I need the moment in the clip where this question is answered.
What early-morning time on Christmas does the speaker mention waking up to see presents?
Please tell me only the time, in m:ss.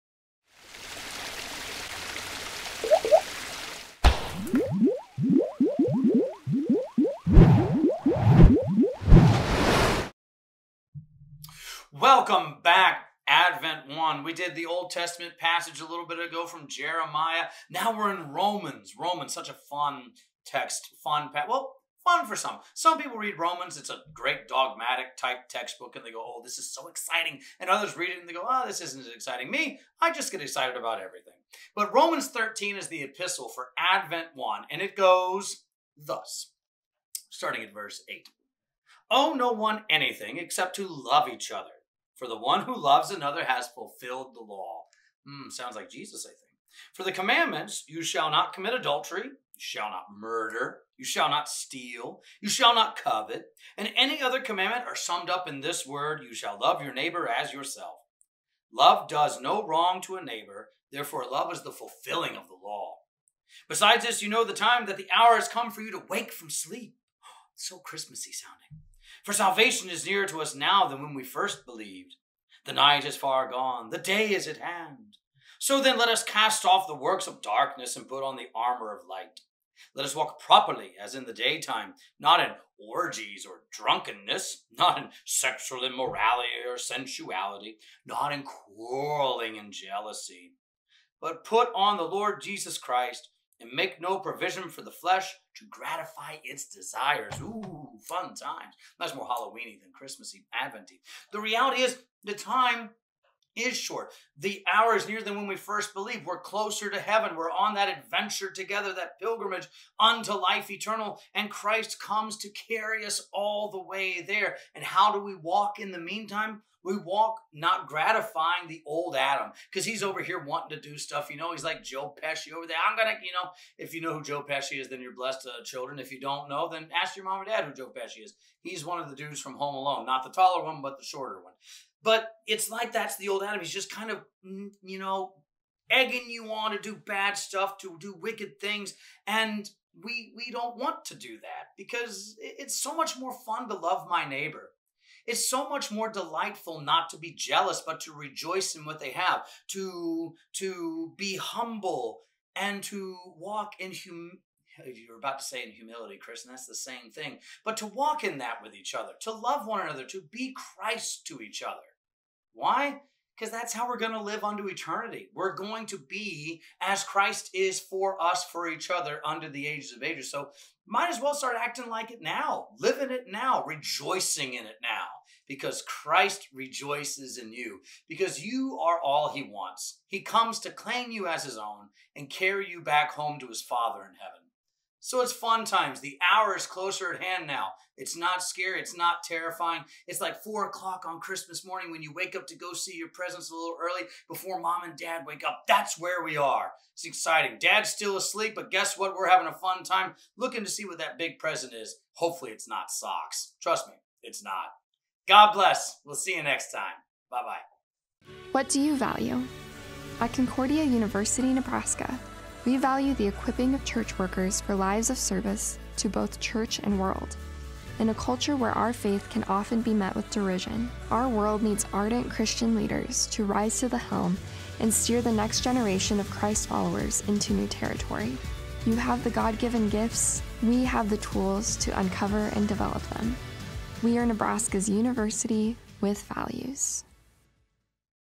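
3:10.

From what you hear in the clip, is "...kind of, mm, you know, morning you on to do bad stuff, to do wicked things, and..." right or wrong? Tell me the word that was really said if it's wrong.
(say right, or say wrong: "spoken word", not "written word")
wrong: "egging", not "morning".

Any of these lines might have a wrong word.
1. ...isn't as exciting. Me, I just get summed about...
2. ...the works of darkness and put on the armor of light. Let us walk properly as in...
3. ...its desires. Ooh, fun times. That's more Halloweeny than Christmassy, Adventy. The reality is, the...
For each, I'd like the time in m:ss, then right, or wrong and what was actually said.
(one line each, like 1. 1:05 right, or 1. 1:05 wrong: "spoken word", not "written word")
1. 0:28 wrong: "excited", not "summed"
2. 1:16 right
3. 1:36 right.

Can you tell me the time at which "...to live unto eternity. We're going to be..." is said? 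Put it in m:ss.
2:44.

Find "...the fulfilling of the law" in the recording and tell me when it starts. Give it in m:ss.
1:01.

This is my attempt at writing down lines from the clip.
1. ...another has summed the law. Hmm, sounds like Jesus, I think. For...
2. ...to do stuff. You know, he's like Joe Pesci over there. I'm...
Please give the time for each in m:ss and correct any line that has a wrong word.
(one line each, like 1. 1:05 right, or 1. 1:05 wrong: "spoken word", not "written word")
1. 0:43 wrong: "fulfilled", not "summed"
2. 2:00 right.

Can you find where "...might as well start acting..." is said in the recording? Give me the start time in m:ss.
2:50.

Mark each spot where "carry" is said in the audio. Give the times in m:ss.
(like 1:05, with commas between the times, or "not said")
1:52, 3:02.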